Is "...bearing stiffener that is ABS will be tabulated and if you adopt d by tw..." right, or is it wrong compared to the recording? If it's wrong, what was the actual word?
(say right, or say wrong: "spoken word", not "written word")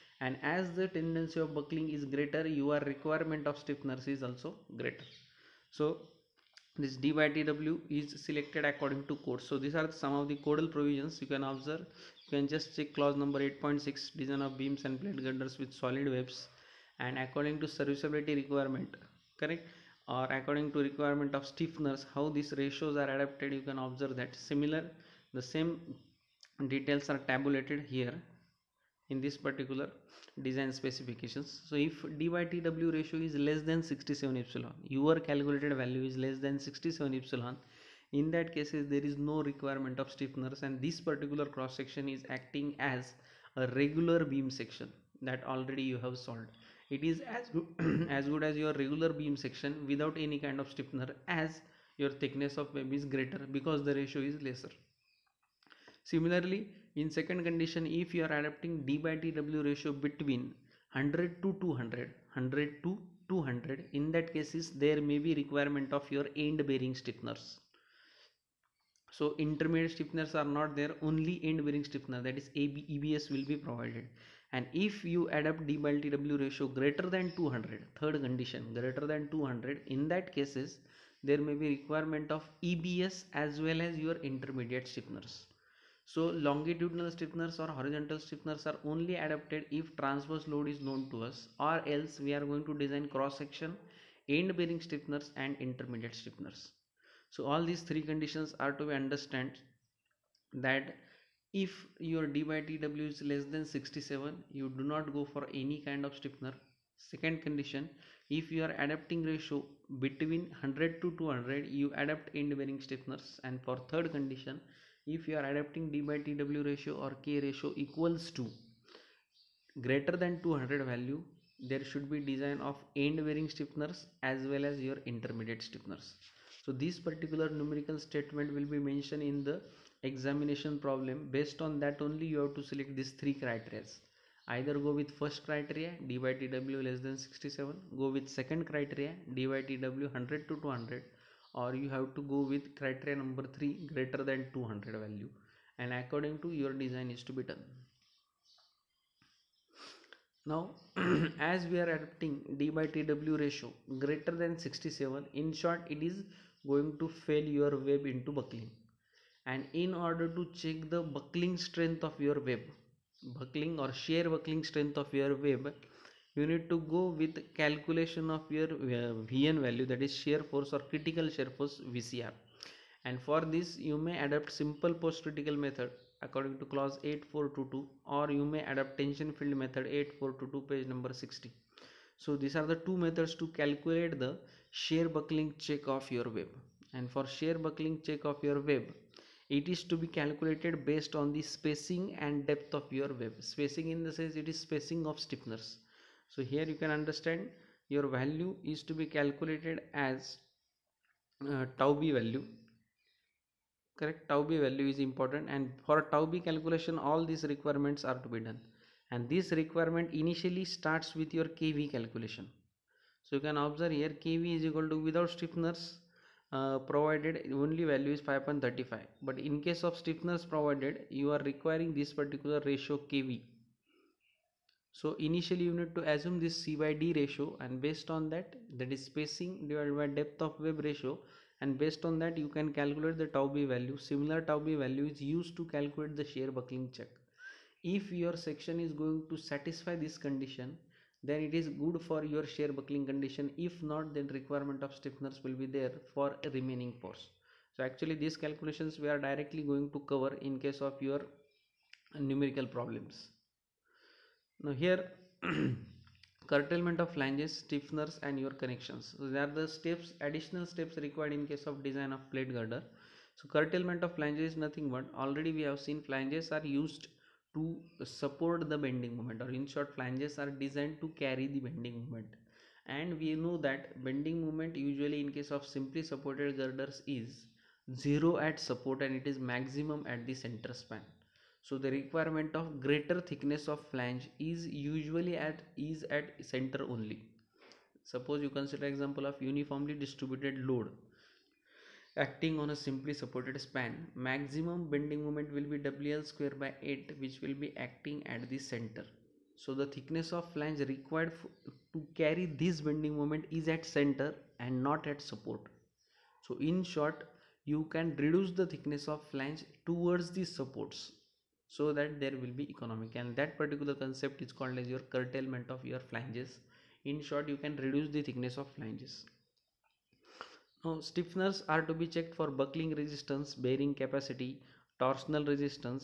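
wrong: "provided", not "tabulated".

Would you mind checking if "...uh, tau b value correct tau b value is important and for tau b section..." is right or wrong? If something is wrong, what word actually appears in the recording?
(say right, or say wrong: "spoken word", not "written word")
wrong: "calculation", not "section".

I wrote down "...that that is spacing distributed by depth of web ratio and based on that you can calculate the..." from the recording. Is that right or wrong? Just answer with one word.
wrong.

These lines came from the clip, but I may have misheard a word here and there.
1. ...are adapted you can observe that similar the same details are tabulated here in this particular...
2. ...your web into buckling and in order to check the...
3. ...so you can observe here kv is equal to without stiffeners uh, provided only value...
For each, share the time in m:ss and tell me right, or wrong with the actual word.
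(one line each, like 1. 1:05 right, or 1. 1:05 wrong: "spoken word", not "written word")
1. 0:23 right
2. 2:37 right
3. 3:33 right.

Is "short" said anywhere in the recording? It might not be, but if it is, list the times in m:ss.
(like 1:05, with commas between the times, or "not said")
2:35, 4:29, 5:06, 5:17.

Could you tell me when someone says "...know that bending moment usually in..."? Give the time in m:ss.
4:33.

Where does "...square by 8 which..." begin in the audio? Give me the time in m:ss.
4:56.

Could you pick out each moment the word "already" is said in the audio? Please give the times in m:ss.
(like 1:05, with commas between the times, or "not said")
0:45, 4:25.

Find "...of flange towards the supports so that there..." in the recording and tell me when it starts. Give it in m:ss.
5:09.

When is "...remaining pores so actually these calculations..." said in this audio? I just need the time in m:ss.
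4:06.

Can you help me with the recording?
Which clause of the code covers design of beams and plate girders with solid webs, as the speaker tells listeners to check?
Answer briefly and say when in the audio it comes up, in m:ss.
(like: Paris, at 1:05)
8.6, at 0:13.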